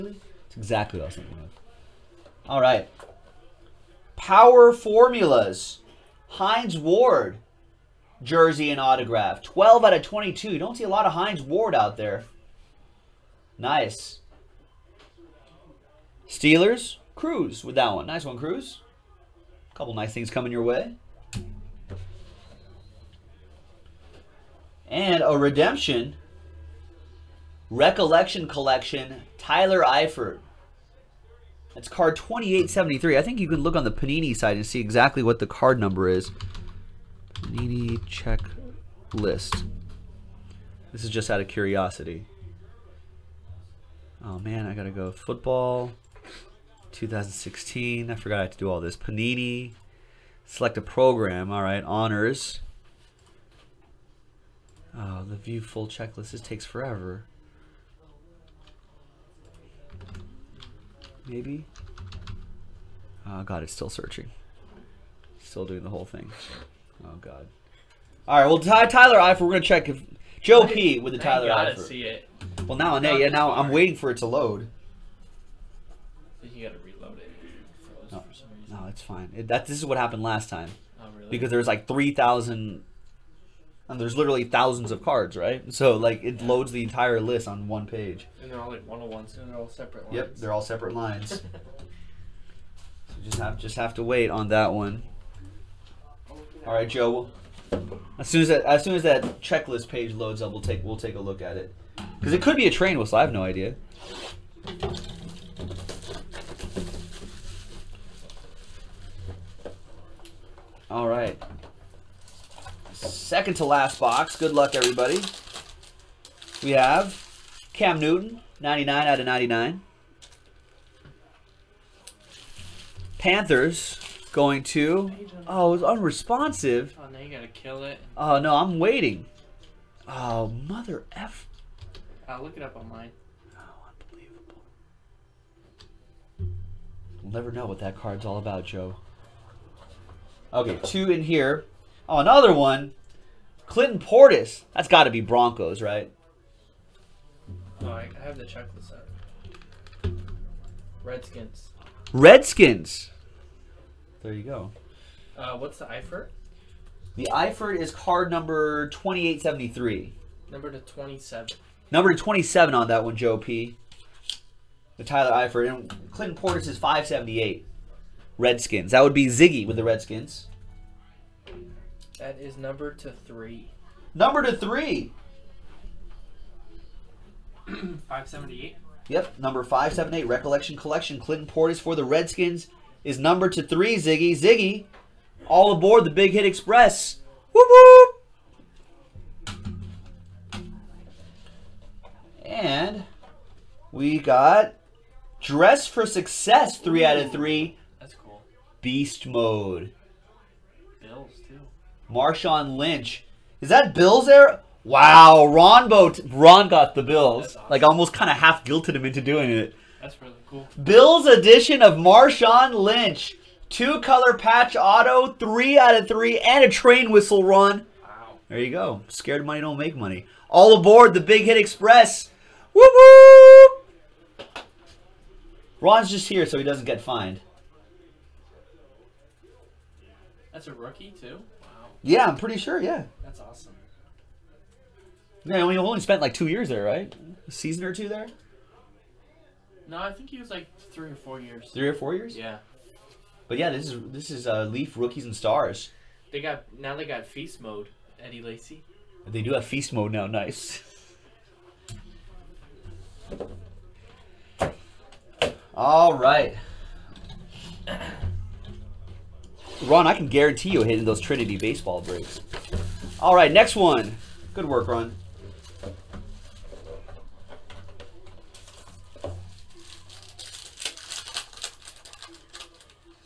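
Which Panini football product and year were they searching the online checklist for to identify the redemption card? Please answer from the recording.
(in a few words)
2016 Honors.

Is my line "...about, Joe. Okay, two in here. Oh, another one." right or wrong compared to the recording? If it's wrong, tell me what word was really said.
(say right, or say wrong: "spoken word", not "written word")
right.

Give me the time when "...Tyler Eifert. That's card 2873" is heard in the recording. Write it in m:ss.
0:29.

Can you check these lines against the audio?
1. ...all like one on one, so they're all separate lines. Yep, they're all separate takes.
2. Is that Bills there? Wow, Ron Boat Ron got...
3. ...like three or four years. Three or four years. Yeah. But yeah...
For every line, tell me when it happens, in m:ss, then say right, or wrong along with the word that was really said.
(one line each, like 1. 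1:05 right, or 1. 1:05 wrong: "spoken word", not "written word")
1. 1:28 wrong: "lines", not "takes"
2. 3:23 right
3. 4:00 right.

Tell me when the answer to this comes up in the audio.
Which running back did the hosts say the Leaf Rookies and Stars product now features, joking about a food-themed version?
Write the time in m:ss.
4:08.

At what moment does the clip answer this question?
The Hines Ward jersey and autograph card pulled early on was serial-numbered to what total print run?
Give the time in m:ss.
0:09.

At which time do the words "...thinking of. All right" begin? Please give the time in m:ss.
0:01.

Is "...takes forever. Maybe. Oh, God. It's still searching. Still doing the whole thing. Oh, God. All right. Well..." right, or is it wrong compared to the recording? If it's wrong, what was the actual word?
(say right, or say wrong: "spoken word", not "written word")
right.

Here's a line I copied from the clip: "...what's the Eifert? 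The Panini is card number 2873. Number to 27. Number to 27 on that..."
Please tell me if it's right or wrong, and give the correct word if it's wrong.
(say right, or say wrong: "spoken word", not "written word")
wrong: "Eifert", not "Panini".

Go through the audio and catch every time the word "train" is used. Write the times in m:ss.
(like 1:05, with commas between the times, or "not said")
1:42, 3:36.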